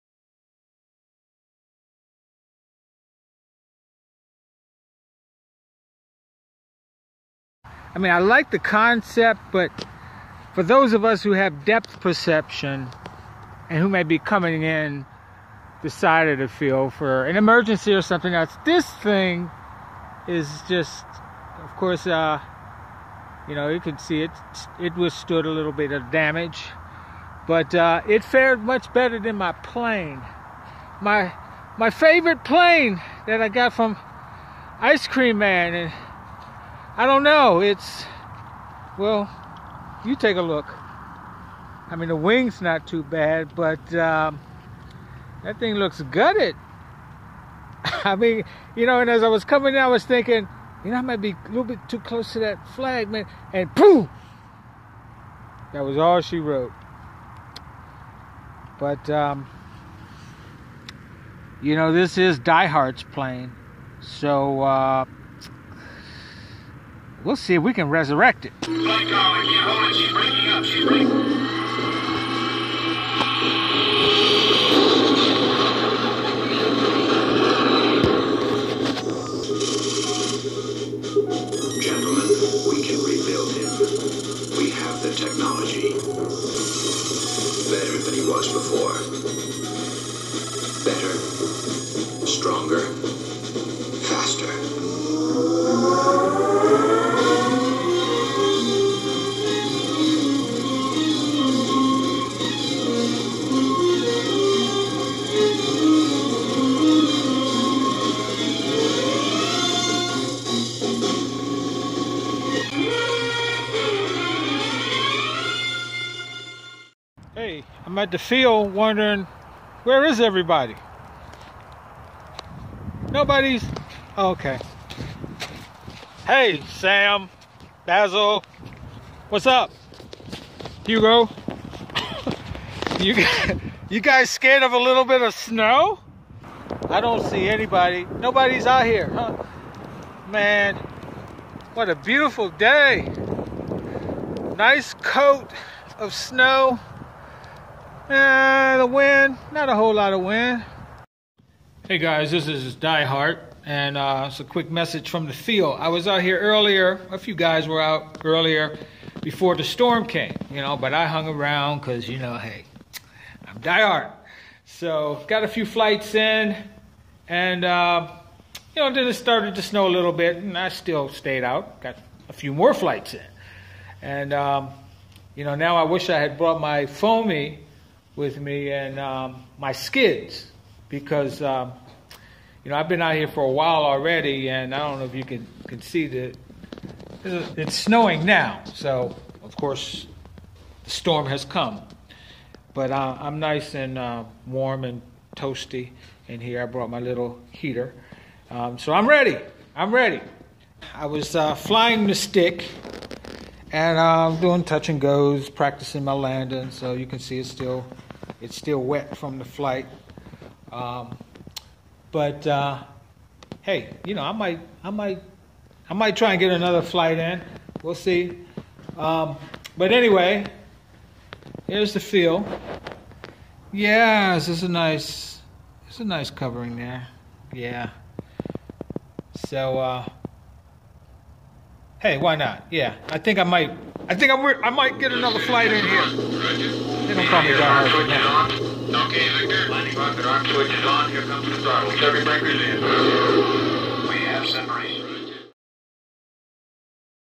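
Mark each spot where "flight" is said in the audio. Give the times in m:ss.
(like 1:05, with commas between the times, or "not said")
2:45, 2:52, 3:29, 3:36, 3:55.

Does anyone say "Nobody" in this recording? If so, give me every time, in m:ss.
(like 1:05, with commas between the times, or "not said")
2:03, 2:18.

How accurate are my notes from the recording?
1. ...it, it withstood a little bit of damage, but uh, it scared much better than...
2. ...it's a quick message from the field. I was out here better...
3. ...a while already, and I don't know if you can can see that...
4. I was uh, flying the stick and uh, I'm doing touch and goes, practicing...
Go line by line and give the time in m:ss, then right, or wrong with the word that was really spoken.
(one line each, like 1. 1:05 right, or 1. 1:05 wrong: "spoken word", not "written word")
1. 0:24 wrong: "fared", not "scared"
2. 2:34 wrong: "earlier", not "better"
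3. 3:03 right
4. 3:20 right.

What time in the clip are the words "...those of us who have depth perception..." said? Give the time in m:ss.
0:10.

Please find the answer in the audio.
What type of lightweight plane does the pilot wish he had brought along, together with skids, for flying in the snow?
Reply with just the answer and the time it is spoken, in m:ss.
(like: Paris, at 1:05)
foamy, at 2:56.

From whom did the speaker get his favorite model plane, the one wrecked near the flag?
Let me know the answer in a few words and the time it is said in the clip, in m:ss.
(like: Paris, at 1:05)
Ice Cream Man, at 0:34.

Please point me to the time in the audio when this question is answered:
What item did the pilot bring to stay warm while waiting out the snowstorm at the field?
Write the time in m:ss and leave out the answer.
3:17.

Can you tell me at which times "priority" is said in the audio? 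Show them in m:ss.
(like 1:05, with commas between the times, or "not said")
not said.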